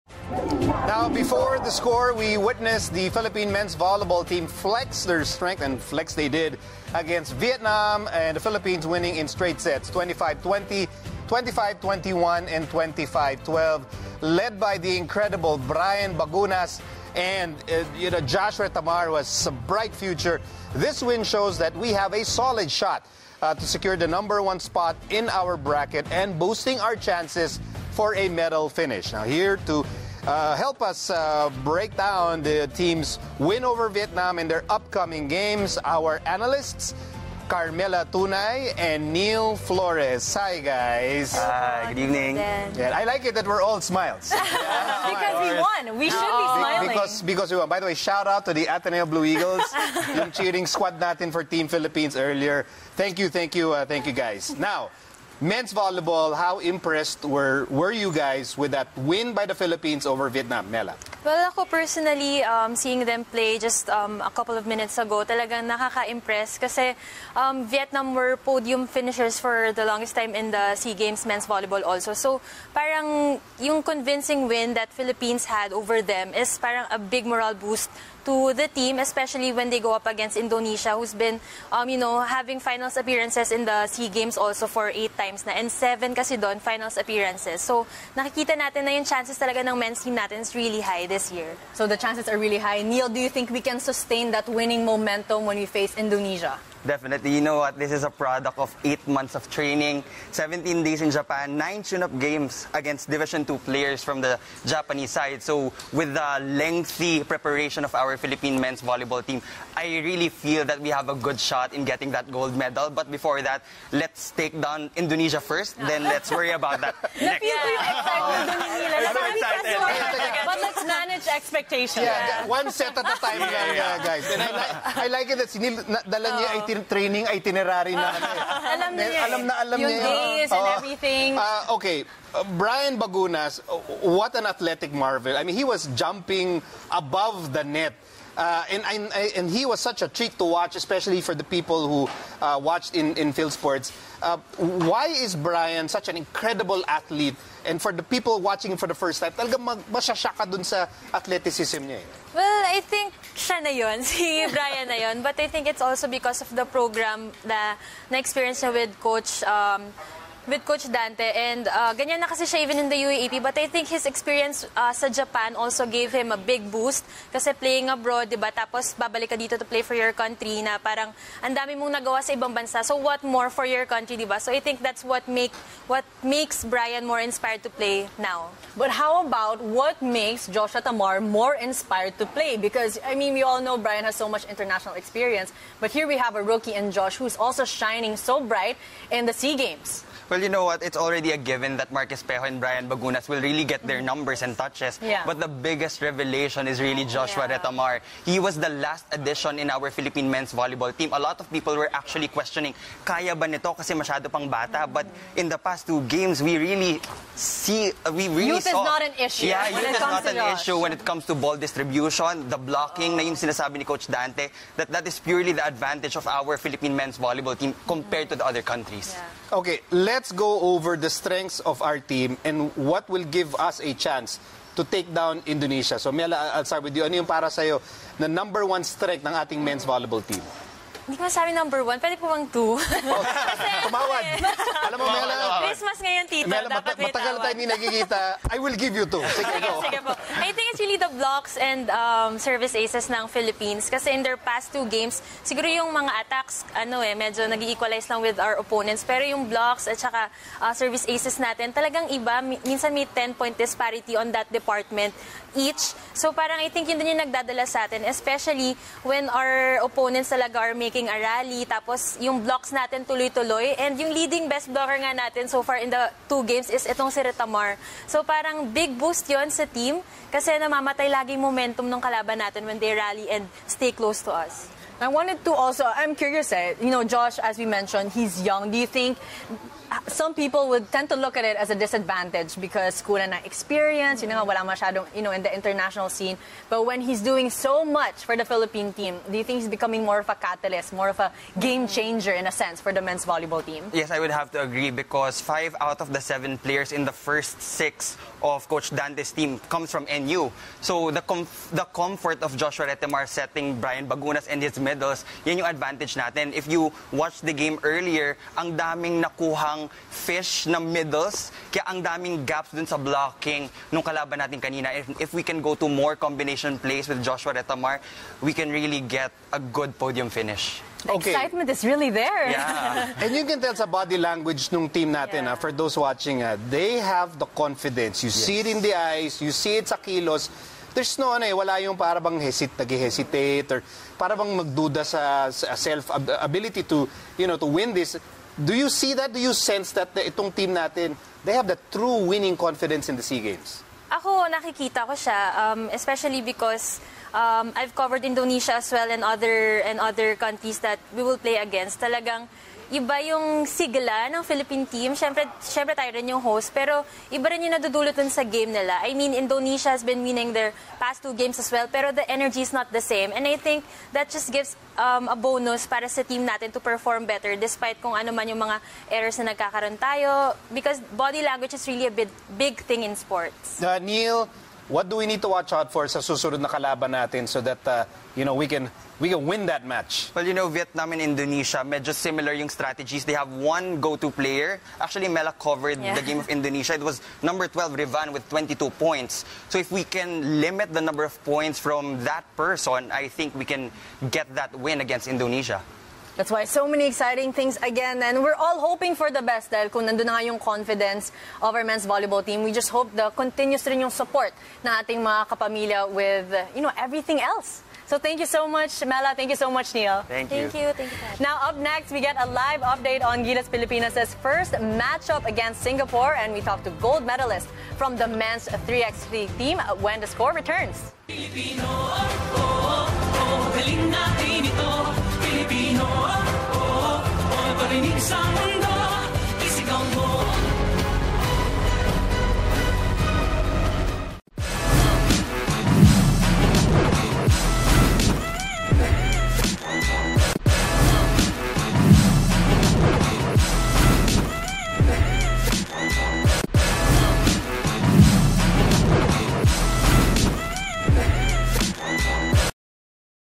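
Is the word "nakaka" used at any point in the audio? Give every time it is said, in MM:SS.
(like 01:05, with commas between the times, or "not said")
01:05.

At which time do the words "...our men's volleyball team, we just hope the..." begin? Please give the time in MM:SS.
06:41.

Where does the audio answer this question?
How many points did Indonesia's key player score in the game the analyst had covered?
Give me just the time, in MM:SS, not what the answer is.
06:28.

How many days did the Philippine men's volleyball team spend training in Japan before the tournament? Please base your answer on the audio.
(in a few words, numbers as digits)
17.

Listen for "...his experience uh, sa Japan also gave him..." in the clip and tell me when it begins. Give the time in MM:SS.
02:43.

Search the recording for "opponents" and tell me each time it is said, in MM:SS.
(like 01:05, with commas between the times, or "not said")
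04:08, 04:19.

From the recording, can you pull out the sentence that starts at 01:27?
So, nakikita natin na yung chances talaga ng men's team natin is really high this year.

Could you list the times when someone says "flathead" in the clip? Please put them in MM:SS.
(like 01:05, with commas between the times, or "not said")
not said.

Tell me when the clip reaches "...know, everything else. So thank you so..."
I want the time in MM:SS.
06:46.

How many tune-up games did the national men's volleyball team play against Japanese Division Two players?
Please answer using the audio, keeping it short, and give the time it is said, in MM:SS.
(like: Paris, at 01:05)
9, at 01:41.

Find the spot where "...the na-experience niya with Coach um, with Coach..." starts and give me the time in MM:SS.
02:37.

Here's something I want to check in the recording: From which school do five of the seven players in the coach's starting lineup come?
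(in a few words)
NU.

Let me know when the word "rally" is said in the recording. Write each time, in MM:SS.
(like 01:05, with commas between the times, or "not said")
04:21, 04:32.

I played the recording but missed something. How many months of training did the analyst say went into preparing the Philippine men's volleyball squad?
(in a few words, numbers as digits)
8.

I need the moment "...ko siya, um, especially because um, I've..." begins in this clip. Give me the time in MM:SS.
05:45.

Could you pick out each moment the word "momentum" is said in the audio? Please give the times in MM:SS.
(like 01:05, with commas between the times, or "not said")
01:34, 04:31.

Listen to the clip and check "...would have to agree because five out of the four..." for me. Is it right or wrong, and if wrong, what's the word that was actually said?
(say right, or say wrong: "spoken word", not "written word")
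wrong: "seven", not "four".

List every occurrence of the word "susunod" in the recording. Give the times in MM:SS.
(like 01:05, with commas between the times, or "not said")
06:16.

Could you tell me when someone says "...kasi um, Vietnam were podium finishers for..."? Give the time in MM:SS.
01:06.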